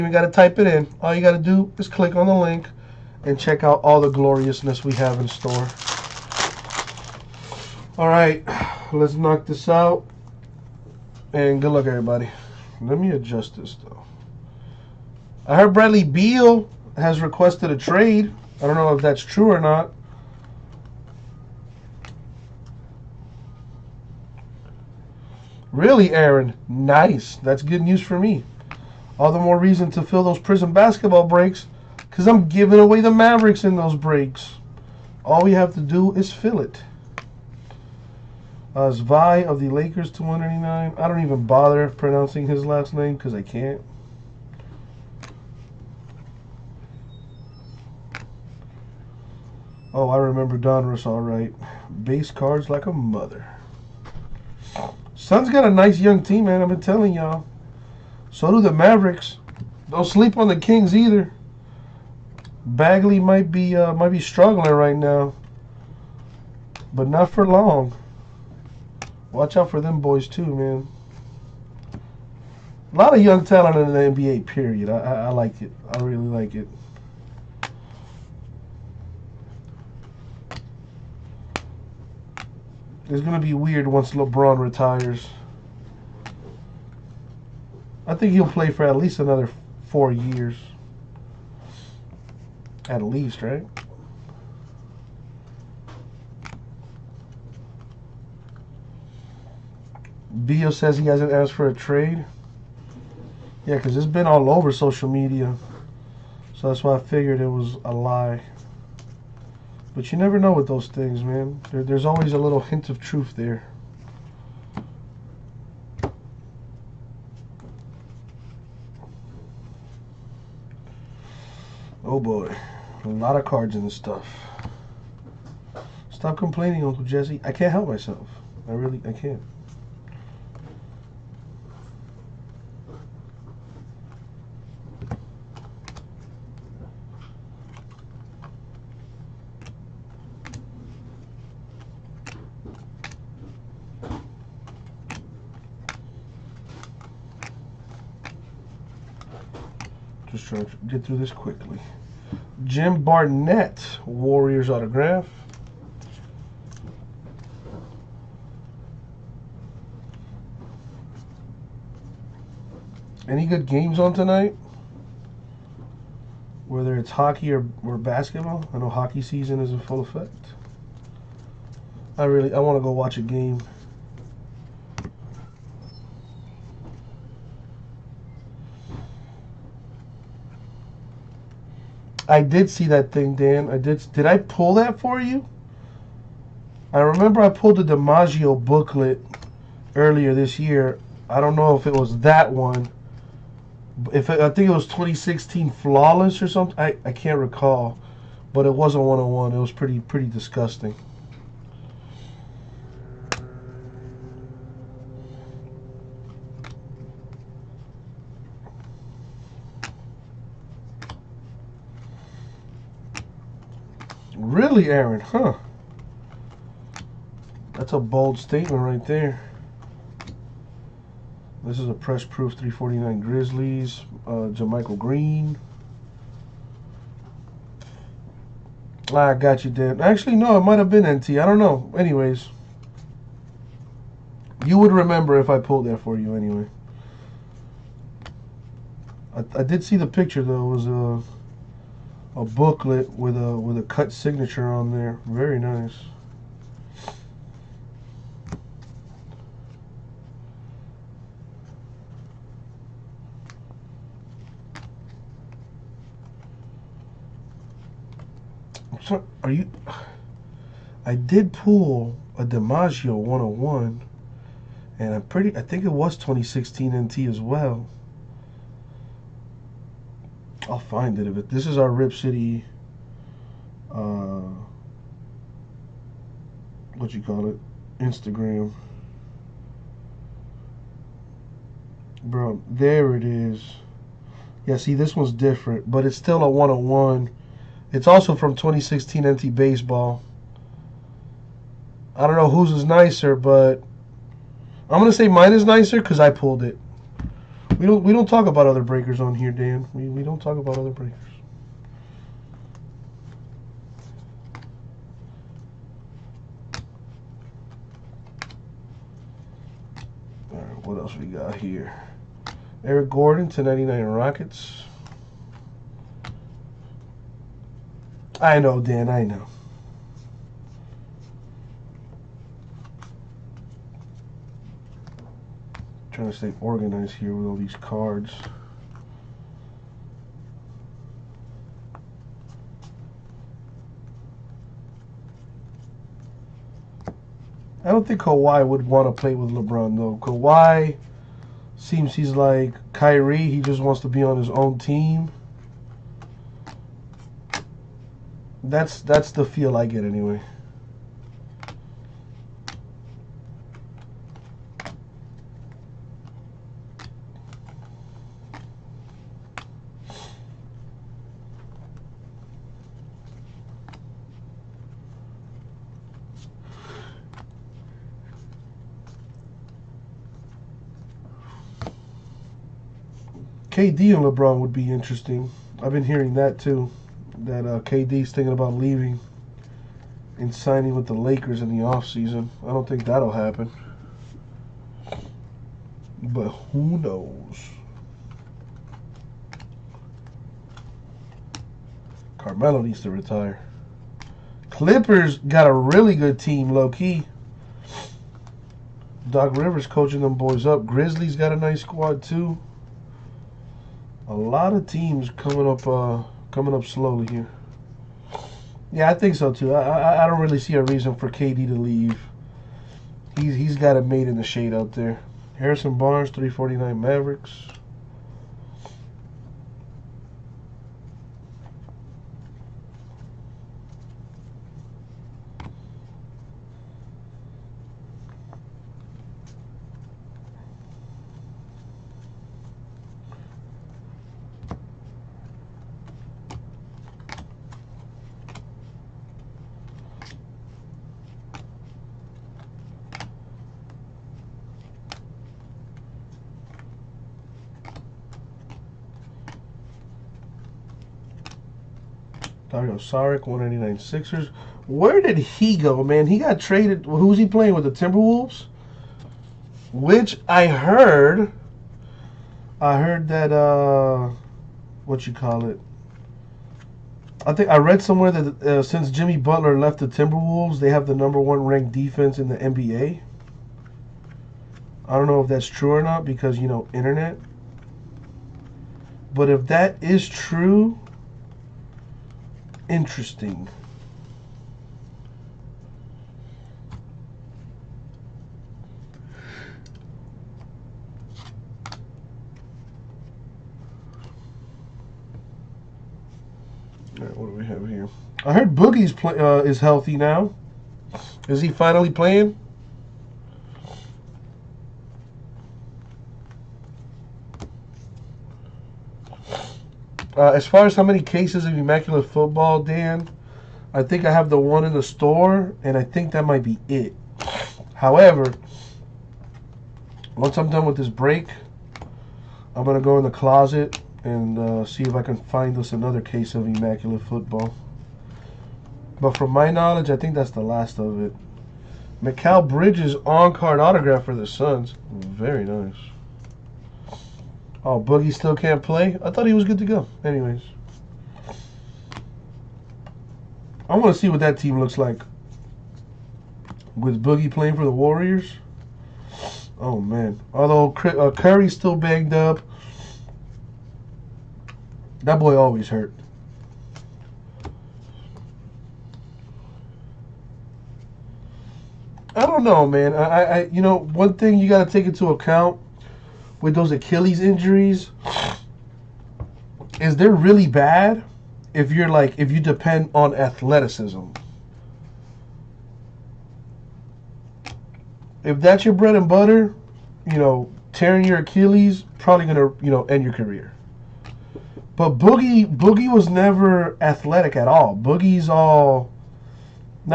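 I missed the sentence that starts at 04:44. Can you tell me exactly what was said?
Yeah, see, this one's different, but it's still a 101.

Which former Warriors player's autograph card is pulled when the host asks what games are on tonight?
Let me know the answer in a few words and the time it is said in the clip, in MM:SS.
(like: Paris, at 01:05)
Jim Barnett, at 02:32.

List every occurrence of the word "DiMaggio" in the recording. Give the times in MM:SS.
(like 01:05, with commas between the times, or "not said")
03:07, 04:22.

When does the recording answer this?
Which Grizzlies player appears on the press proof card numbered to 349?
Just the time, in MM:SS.
03:44.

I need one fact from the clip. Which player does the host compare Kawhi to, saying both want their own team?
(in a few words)
Kyrie.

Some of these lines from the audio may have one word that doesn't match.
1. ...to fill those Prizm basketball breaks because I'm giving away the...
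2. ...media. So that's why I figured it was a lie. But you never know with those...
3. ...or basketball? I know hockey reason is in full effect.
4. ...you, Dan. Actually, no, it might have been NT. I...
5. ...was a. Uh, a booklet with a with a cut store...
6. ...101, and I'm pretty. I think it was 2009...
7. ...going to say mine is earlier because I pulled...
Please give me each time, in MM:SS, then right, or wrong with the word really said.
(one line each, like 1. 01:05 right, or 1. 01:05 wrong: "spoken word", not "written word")
1. 00:29 right
2. 01:45 right
3. 02:47 wrong: "season", not "reason"
4. 03:49 right
5. 04:00 wrong: "signature", not "store"
6. 04:23 wrong: "2016", not "2009"
7. 04:54 wrong: "nicer", not "earlier".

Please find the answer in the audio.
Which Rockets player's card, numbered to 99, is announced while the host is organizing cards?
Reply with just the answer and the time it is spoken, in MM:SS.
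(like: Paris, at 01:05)
Eric Gordon, at 05:12.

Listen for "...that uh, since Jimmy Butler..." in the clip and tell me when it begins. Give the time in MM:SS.
07:48.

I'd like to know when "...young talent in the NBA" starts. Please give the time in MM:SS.
01:13.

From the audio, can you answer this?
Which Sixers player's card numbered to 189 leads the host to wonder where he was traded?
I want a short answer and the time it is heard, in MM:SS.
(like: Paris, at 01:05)
Dario Saric, at 07:32.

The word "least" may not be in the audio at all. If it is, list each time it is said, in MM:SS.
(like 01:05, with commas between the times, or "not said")
01:28, 01:33.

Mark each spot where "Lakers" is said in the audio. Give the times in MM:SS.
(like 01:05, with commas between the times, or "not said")
00:39, 06:21.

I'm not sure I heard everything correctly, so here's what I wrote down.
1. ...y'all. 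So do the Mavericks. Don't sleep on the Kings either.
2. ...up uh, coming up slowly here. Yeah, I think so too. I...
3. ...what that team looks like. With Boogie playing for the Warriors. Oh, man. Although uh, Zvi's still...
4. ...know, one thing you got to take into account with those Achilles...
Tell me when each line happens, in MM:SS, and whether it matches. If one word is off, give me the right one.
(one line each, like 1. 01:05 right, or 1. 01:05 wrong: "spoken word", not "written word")
1. 00:57 right
2. 06:45 right
3. 09:04 wrong: "Curry", not "Zvi"
4. 09:23 right.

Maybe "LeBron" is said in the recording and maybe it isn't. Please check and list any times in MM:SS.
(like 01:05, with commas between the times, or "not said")
01:24, 05:39, 06:14.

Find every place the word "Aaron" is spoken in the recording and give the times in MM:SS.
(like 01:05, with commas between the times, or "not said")
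00:26, 03:34.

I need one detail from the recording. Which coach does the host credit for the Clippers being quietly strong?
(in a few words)
Doc Rivers.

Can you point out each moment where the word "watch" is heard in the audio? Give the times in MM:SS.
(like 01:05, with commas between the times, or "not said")
01:09, 02:52.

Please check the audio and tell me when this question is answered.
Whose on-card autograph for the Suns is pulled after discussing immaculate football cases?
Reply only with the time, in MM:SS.
08:52.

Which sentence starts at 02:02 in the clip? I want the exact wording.
Oh boy, a lot of cards in this stuff.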